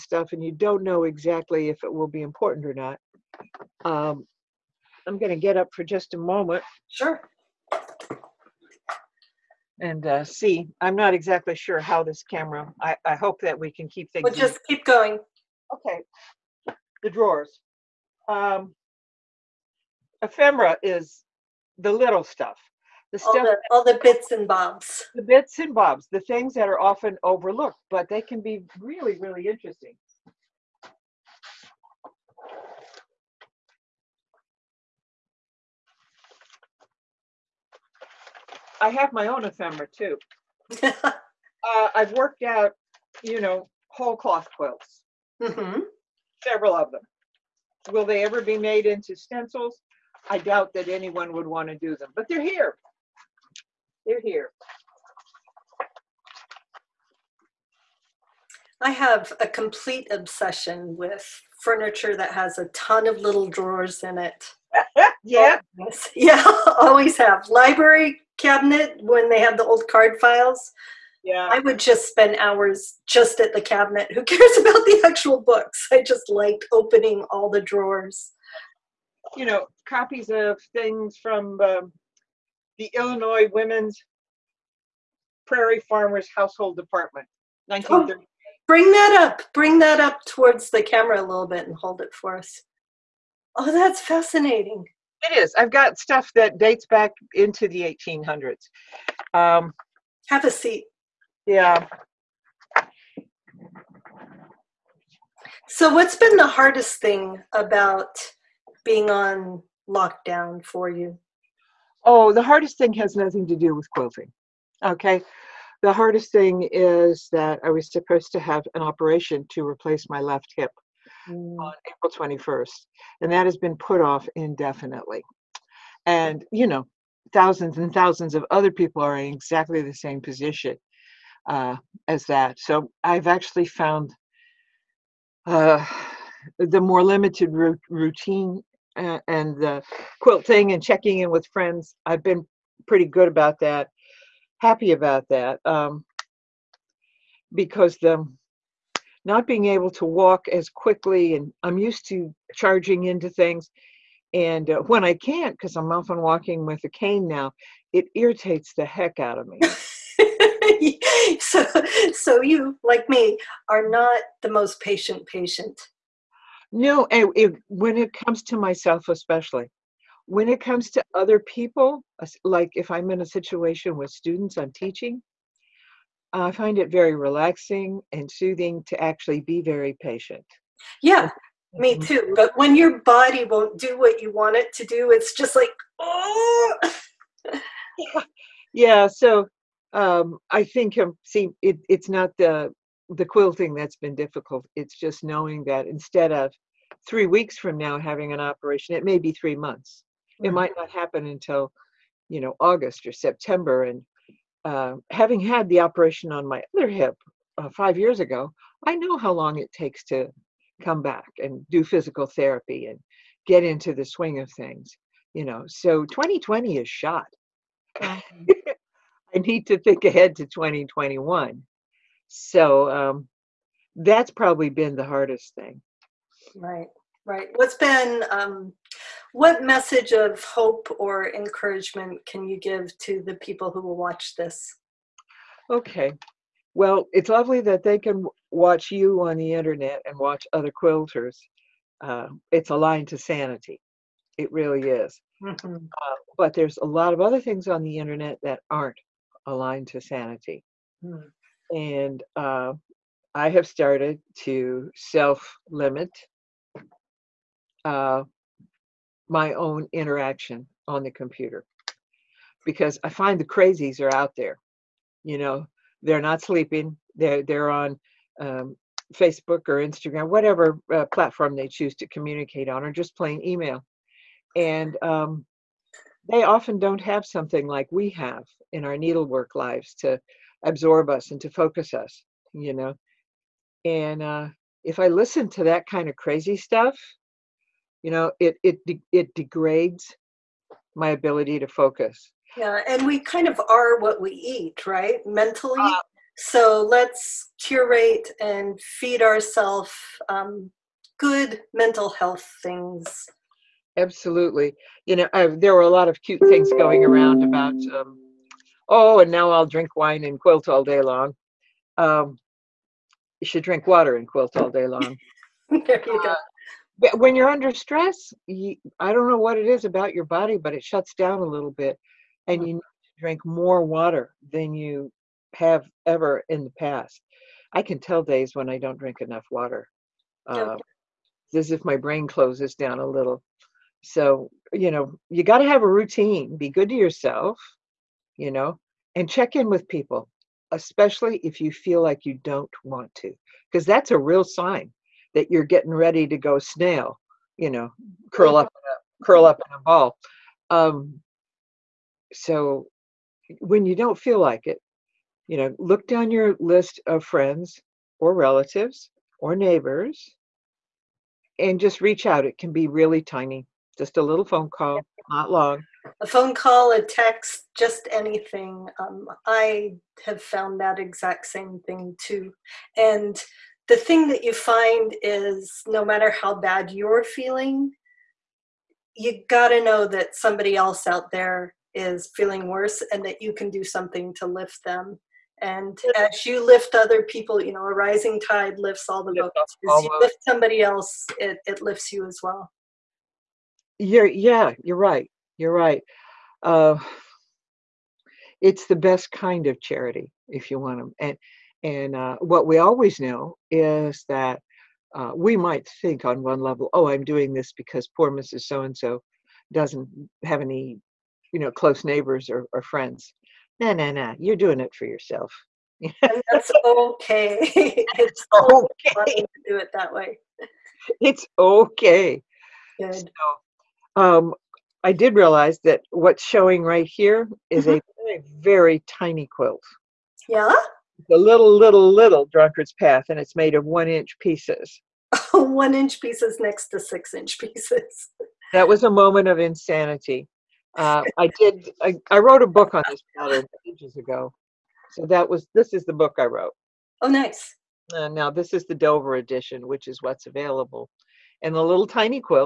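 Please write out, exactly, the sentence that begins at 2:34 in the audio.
And uh, when I can't, because I'm often walking with a cane now, it irritates the heck out of me.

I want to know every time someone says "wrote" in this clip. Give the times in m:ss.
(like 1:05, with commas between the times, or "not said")
7:22, 7:26.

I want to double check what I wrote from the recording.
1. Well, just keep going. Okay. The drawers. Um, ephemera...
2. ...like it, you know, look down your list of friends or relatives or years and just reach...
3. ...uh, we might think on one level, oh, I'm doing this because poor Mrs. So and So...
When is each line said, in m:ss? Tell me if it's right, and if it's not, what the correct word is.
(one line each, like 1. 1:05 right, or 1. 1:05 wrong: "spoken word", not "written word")
1. 0:14 right
2. 5:54 wrong: "neighbors", not "years"
3. 6:45 right.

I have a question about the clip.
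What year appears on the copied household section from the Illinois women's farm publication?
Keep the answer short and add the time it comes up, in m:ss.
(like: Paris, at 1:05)
1930, at 1:27.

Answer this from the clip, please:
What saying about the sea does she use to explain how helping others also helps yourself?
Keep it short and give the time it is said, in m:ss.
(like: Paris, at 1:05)
a rising tide lifts all the boats, at 6:27.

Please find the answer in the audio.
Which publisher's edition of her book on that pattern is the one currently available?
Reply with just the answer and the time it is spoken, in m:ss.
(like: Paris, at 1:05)
Dover, at 7:28.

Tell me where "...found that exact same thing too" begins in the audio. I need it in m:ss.
6:10.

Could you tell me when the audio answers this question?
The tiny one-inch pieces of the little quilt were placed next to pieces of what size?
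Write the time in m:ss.
7:16.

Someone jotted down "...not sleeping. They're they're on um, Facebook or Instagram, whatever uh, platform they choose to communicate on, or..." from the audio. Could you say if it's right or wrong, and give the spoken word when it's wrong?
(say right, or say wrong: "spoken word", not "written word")
right.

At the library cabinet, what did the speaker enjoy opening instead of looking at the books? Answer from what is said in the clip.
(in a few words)
card files.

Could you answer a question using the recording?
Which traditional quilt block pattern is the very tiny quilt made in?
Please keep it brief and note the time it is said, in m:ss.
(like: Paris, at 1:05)
drunkard's path, at 7:12.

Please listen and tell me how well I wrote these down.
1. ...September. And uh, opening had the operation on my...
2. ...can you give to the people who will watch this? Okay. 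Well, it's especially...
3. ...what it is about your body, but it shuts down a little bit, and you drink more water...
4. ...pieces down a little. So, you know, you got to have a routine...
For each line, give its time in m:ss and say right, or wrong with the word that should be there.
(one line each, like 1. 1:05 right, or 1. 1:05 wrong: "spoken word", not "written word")
1. 3:23 wrong: "having", not "opening"
2. 3:52 wrong: "lovely", not "especially"
3. 5:19 right
4. 5:32 wrong: "closes", not "pieces".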